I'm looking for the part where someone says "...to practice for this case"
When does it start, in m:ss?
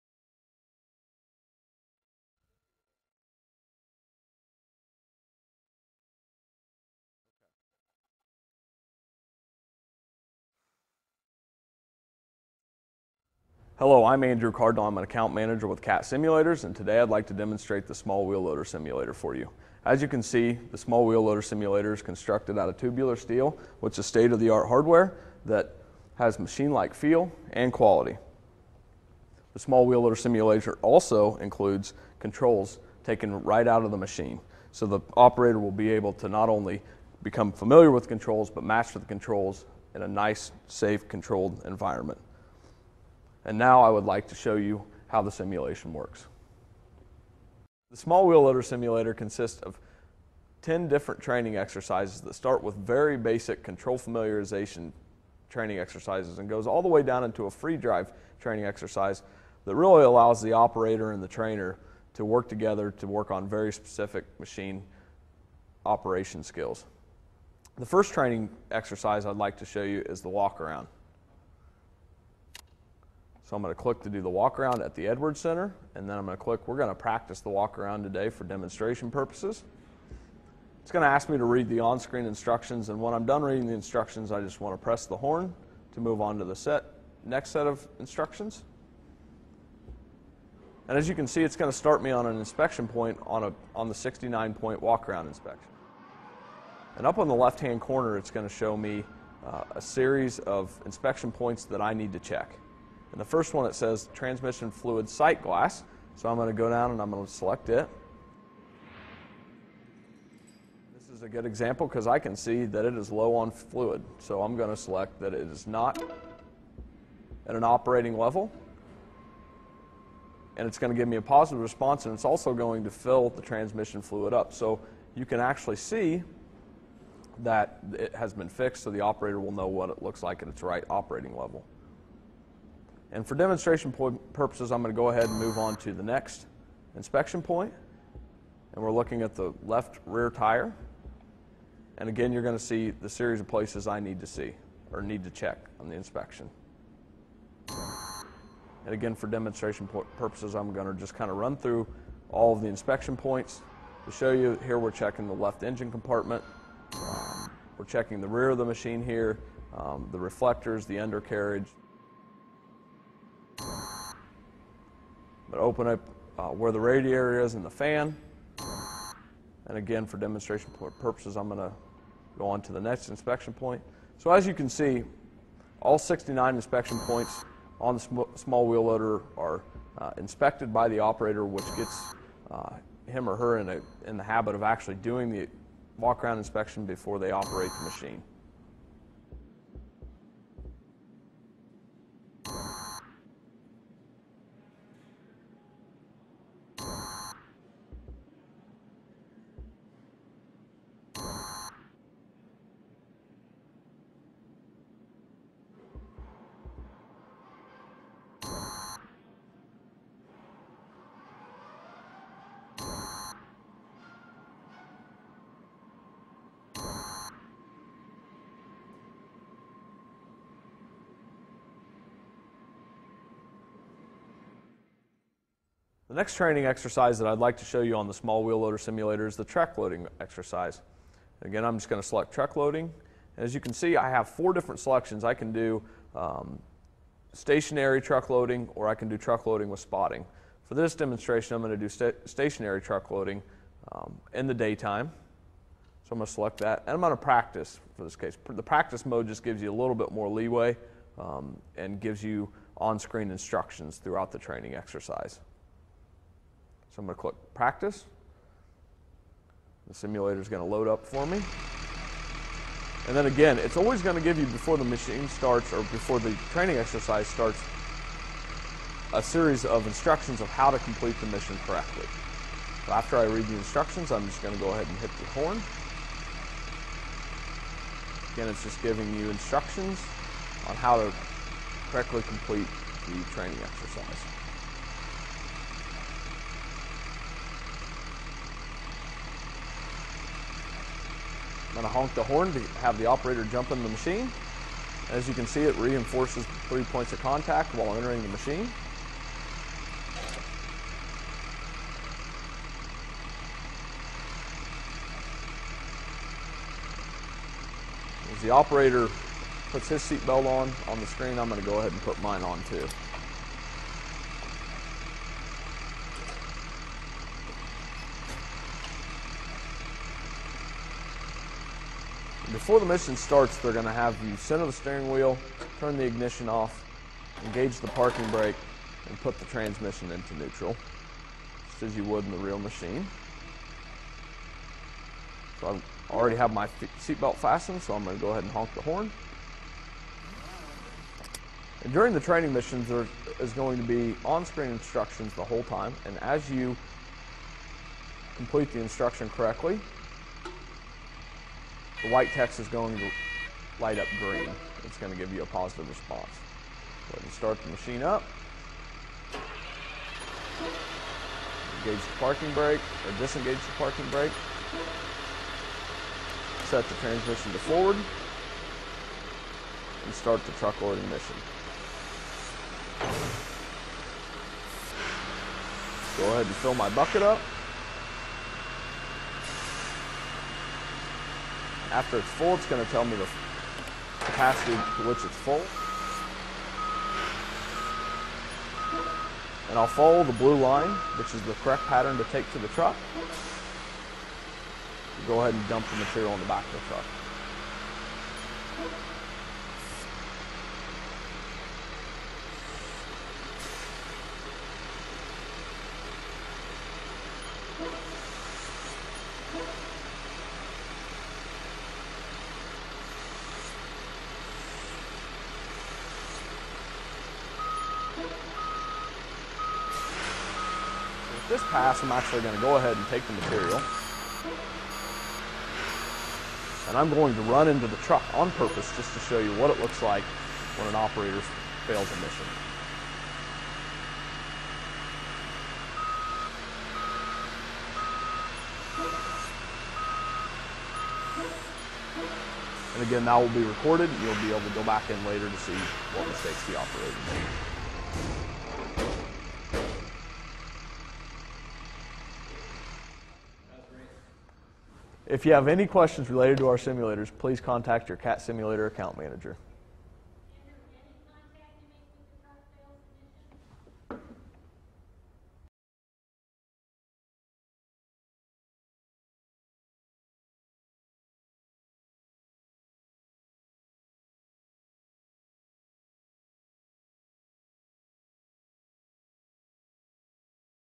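4:07.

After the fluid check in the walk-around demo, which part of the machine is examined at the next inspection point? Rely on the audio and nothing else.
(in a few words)
left rear tire.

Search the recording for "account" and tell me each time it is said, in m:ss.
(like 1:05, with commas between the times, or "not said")
0:15, 7:38.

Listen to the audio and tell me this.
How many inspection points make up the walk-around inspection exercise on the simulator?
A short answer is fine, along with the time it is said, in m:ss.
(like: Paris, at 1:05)
69, at 1:33.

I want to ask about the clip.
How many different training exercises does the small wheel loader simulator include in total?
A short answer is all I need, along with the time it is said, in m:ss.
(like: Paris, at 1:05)
10, at 0:50.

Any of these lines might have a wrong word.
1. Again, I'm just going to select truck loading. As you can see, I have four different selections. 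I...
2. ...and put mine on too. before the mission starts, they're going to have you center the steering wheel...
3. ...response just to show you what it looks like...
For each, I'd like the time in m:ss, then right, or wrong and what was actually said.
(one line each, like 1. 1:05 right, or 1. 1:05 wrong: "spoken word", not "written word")
1. 3:51 right
2. 5:11 right
3. 7:08 wrong: "purpose", not "response".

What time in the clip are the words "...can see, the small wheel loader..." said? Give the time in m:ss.
0:20.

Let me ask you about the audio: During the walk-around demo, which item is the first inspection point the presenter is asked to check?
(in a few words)
transmission fluid sight glass.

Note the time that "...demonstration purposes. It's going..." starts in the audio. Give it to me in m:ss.
1:18.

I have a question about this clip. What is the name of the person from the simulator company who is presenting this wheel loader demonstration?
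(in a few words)
Andrew Cardinal.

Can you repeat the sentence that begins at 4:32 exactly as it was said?
So after I read the instructions, I'm just going to go ahead and hit the horn.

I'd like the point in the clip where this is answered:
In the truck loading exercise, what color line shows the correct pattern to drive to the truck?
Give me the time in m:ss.
6:30.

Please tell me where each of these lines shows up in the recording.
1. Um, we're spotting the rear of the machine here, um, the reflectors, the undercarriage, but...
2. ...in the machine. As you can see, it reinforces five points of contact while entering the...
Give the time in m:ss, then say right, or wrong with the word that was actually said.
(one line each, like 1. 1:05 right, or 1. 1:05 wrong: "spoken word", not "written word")
1. 2:36 wrong: "checking", not "spotting"
2. 4:53 wrong: "three", not "five".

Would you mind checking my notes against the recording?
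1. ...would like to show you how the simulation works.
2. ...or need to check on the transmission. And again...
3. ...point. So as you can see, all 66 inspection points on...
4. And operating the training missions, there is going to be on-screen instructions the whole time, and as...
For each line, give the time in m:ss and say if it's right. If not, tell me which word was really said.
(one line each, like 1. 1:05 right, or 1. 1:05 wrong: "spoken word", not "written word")
1. 0:43 right
2. 2:24 wrong: "inspection", not "transmission"
3. 2:53 wrong: "69", not "66"
4. 5:41 wrong: "during", not "operating".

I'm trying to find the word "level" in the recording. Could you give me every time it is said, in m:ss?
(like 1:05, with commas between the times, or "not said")
1:58, 2:11.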